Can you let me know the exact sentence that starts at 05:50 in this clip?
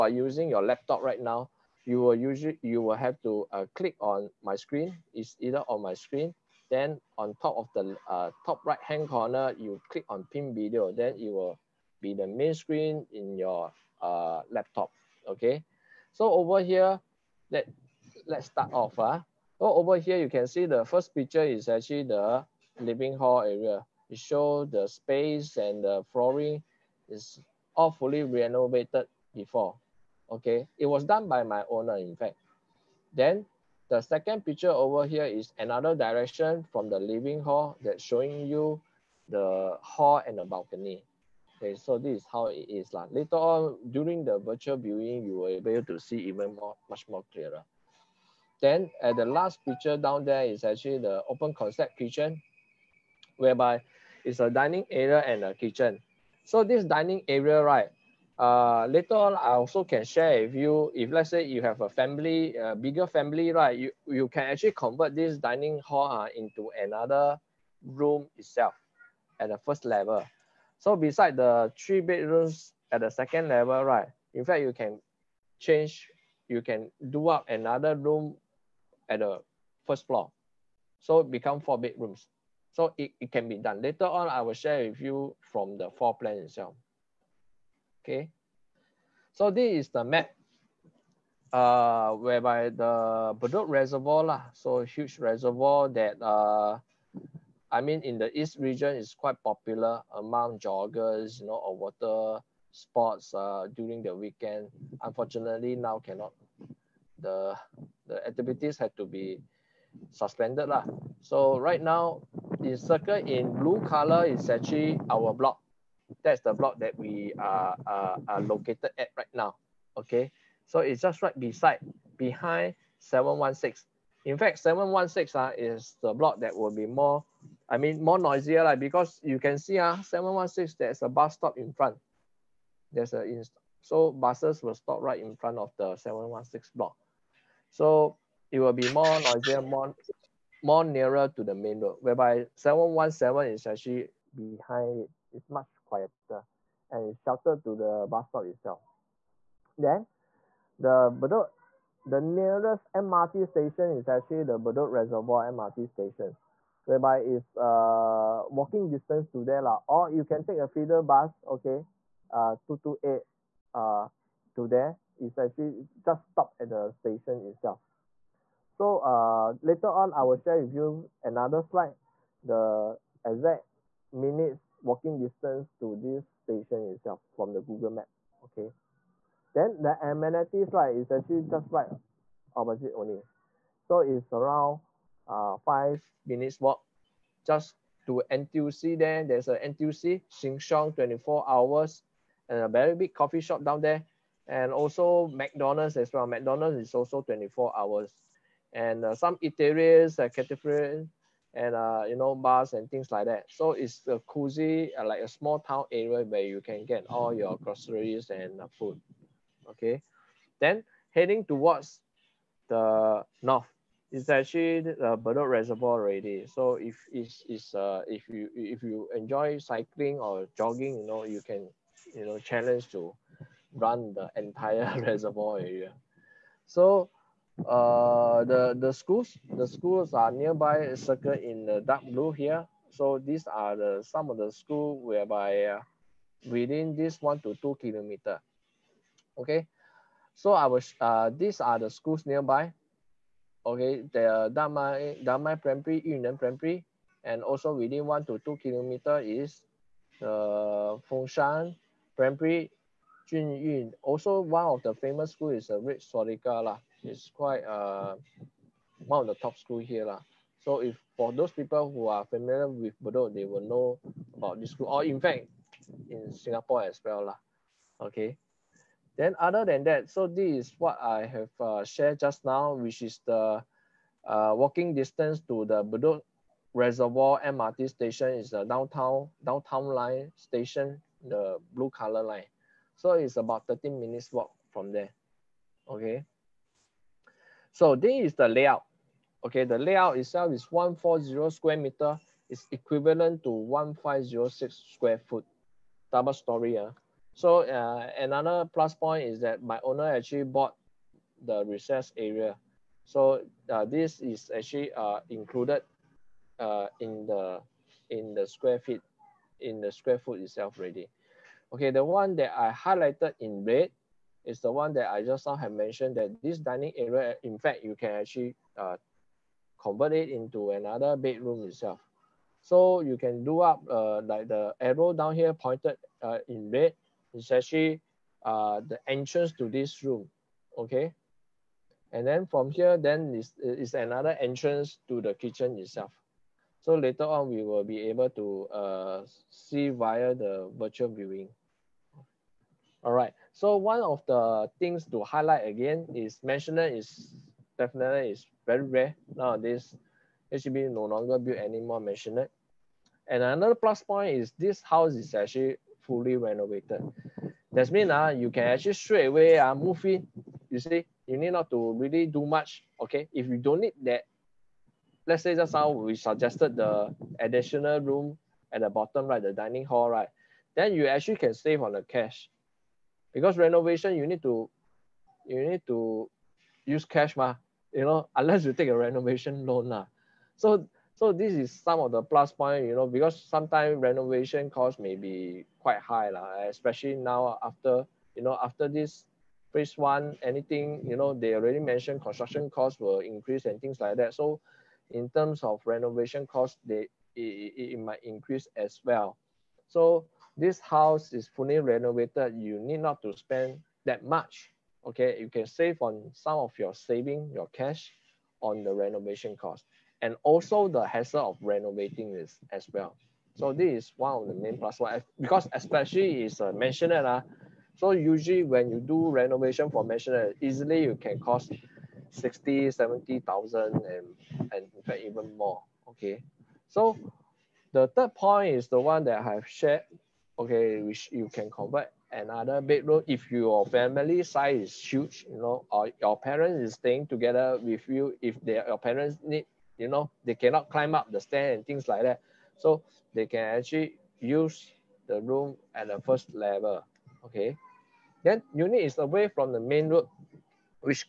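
HDB no longer build any more maisonette.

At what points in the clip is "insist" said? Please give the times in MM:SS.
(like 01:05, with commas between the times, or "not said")
not said.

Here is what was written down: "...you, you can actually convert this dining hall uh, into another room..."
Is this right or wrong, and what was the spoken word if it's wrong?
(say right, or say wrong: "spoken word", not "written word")
right.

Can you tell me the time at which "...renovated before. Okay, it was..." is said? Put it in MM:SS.
00:28.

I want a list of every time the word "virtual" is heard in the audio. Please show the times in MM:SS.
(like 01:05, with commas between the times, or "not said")
00:44, 05:40.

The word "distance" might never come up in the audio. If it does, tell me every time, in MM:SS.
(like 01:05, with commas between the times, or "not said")
02:38, 02:55, 04:34.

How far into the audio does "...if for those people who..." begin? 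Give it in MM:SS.
04:20.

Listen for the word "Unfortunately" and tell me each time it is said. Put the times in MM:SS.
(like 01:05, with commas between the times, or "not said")
01:45.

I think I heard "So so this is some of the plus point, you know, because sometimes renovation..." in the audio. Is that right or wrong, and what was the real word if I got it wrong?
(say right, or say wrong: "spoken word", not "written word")
right.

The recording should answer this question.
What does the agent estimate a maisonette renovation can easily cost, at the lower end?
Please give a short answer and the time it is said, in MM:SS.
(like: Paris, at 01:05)
60,000, at 07:02.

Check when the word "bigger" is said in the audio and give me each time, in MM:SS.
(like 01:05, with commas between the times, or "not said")
01:02.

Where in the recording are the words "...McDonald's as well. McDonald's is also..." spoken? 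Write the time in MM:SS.
03:15.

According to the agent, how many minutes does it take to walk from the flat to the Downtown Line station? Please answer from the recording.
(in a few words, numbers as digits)
13 minutes.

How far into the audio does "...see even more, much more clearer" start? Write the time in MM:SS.
00:45.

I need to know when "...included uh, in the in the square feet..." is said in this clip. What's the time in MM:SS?
05:05.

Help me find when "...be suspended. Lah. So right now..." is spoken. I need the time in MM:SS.
01:49.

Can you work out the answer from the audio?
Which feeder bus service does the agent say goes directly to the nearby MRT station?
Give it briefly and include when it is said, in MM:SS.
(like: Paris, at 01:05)
228, at 02:42.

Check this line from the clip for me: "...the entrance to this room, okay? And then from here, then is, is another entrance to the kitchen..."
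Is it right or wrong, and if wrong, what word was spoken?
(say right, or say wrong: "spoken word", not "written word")
right.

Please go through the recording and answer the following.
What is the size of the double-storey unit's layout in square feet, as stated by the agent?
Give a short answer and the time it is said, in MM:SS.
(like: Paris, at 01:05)
1506 square feet, at 04:53.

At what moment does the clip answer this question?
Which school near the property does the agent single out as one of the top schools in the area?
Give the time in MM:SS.
04:15.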